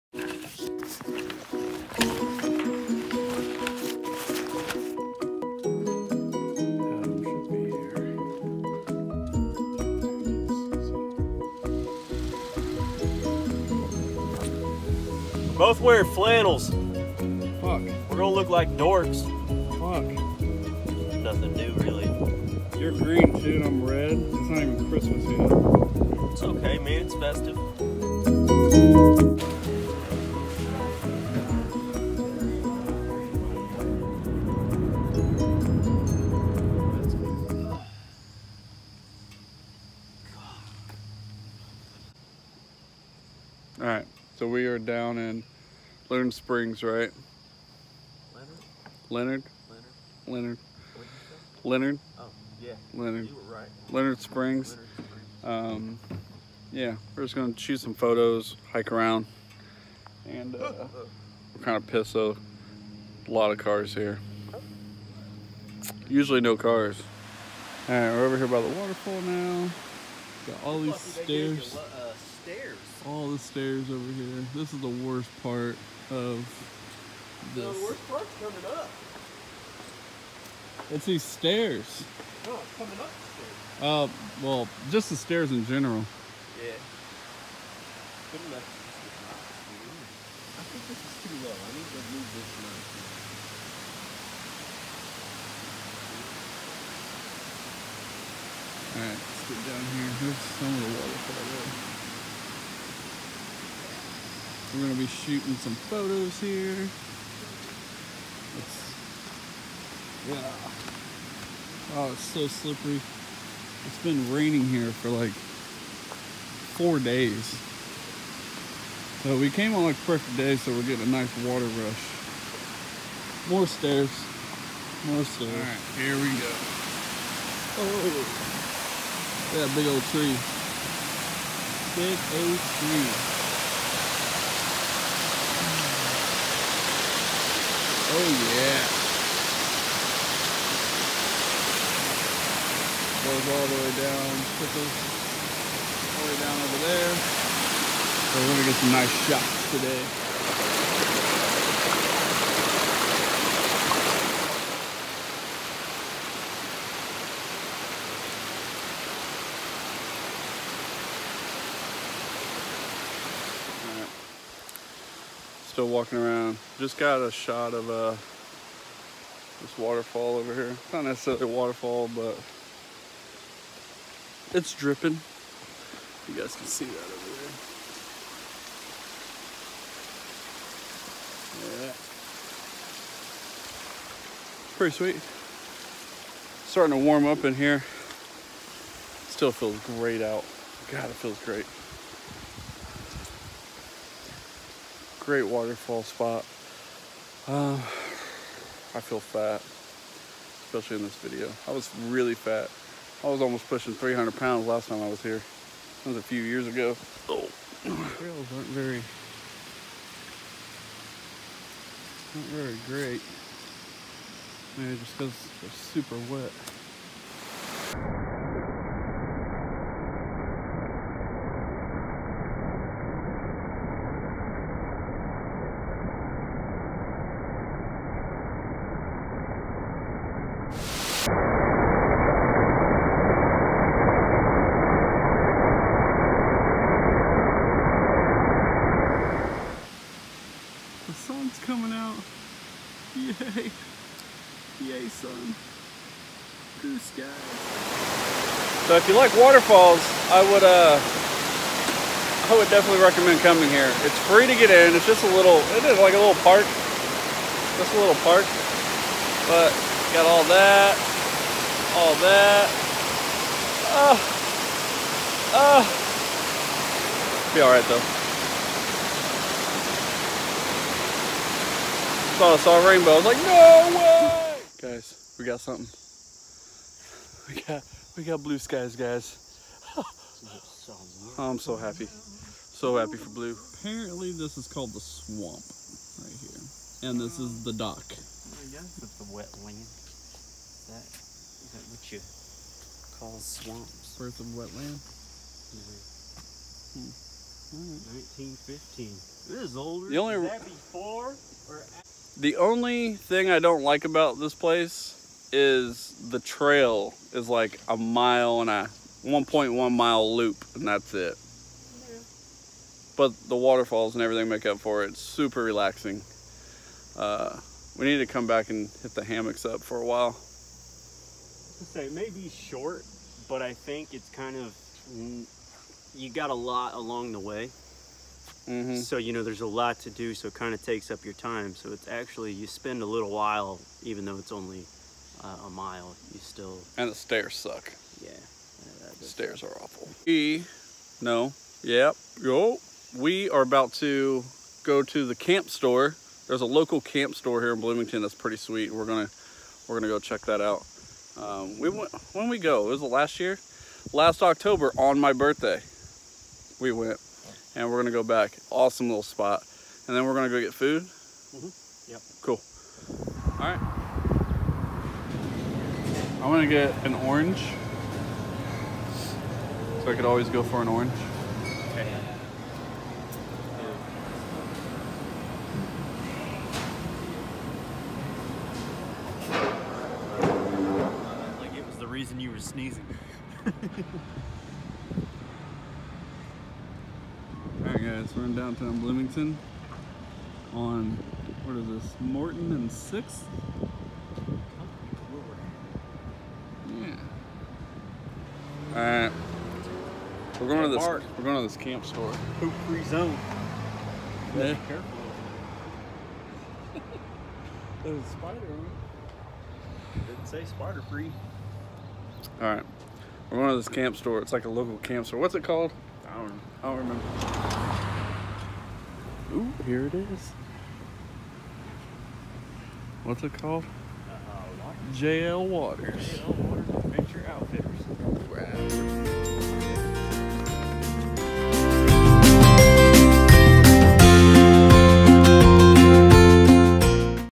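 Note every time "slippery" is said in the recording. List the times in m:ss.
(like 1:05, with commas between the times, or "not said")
1:52.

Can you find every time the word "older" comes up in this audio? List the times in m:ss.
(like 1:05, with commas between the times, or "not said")
4:59.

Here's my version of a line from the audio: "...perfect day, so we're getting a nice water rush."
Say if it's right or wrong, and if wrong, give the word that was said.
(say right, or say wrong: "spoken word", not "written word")
right.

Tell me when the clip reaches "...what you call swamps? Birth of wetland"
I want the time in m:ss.
4:51.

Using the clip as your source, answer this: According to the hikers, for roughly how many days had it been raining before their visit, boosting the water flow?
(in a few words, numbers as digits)
4.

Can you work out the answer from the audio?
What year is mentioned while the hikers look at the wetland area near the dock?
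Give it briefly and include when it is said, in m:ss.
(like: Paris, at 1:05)
1915, at 4:58.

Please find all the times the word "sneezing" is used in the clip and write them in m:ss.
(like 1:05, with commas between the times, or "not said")
6:22.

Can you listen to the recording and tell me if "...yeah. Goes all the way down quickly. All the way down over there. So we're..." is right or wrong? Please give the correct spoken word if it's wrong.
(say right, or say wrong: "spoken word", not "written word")
right.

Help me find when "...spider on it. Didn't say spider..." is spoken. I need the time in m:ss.
6:48.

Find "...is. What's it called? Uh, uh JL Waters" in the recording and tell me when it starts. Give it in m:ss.
7:00.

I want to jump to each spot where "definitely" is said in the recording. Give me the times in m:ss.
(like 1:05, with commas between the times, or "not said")
4:12.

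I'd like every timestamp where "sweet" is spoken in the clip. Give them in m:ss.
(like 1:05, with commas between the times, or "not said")
3:04, 5:48.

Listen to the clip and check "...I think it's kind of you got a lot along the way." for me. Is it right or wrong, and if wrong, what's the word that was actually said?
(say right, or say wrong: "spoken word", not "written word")
right.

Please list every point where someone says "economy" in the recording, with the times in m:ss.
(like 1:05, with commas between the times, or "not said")
not said.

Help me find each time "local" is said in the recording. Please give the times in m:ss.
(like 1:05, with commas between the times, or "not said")
5:46, 6:54.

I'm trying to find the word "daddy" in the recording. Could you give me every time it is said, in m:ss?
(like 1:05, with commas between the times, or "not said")
not said.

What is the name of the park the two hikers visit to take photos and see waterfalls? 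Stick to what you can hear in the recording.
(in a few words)
Leonard Springs.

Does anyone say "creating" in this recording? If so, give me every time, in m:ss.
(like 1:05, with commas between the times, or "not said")
not said.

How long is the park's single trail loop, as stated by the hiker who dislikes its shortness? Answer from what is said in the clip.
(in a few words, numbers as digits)
1.1 miles.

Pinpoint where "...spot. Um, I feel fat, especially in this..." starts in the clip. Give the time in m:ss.
3:16.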